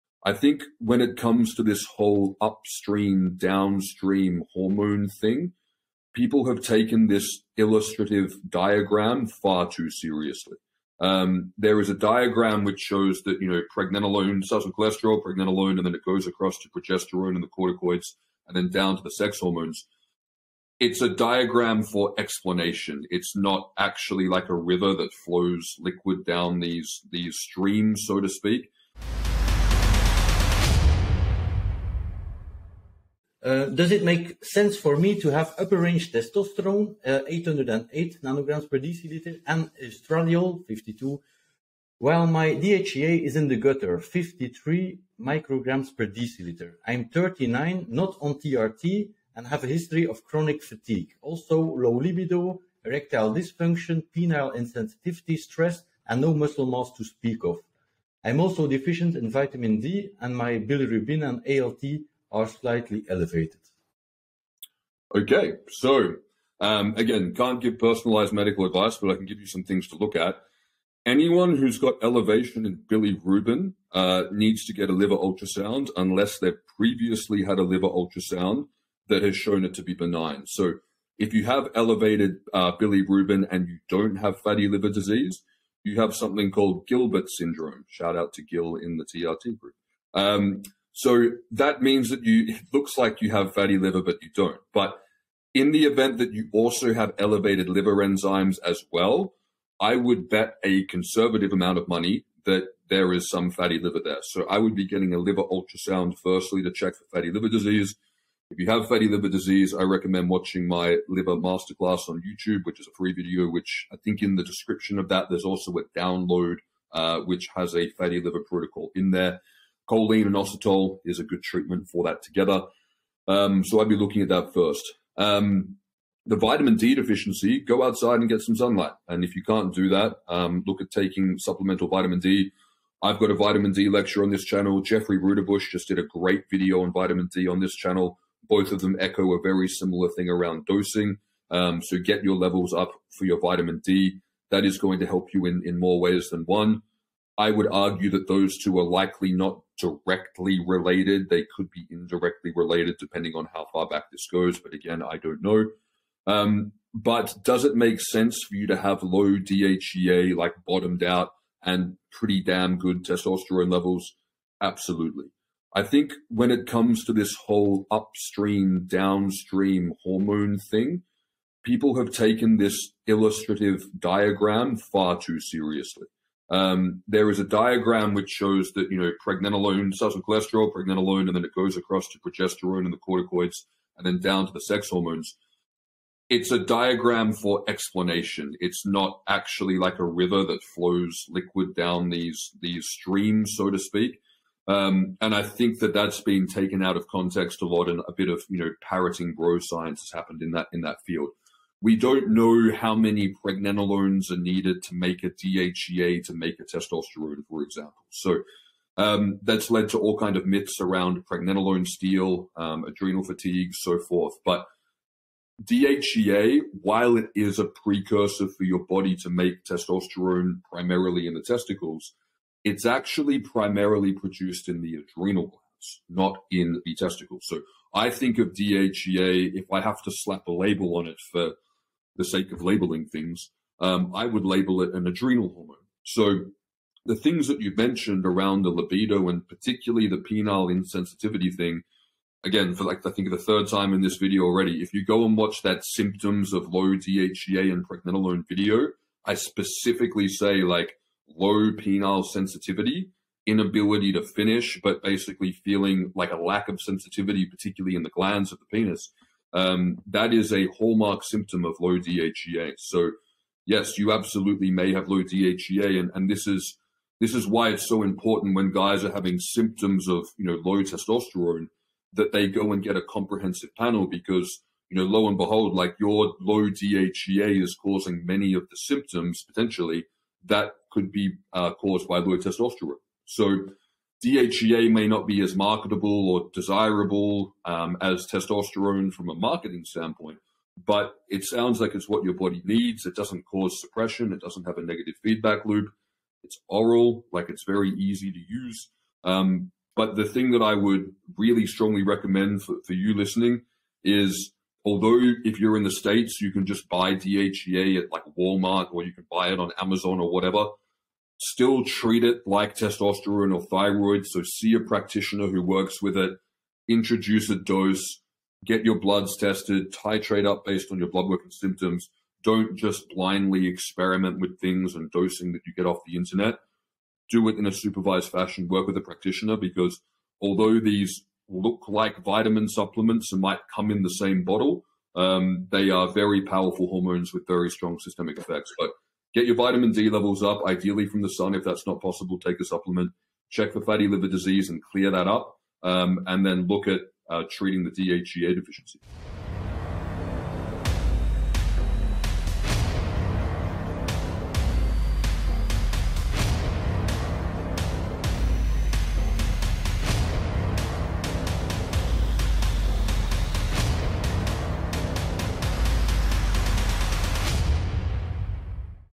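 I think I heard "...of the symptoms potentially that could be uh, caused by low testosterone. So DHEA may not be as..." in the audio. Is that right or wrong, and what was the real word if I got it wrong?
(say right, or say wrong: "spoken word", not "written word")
right.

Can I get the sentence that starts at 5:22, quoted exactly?
Don't just blindly experiment with things and dosing that you get off the internet.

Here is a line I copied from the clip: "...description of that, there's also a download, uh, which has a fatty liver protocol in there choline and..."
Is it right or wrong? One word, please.
right.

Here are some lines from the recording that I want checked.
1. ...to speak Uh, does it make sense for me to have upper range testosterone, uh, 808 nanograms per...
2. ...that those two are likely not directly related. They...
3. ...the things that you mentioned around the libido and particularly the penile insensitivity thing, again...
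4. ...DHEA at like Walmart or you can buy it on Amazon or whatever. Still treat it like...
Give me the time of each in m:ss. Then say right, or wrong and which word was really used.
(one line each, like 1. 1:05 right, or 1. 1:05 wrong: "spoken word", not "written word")
1. 0:28 right
2. 2:28 right
3. 3:57 right
4. 5:07 right.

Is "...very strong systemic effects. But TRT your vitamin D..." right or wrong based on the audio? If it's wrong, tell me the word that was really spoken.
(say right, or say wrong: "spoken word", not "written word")
wrong: "Get", not "TRT".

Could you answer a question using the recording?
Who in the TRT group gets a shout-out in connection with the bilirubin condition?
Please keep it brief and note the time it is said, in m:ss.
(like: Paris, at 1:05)
Gil, at 1:28.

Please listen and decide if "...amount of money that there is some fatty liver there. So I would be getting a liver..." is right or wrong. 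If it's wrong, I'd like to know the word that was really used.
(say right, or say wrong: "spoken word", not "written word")
right.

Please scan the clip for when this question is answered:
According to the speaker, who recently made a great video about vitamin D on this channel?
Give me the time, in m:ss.
2:14.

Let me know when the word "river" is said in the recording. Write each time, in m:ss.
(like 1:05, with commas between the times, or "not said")
0:24, 3:10.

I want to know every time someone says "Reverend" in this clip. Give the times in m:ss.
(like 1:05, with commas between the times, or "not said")
not said.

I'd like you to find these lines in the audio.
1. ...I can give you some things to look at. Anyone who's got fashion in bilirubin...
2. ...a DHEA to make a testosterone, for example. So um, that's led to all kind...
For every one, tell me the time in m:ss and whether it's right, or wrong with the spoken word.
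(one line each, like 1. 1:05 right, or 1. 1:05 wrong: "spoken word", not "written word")
1. 1:09 wrong: "elevation", not "fashion"
2. 3:25 right.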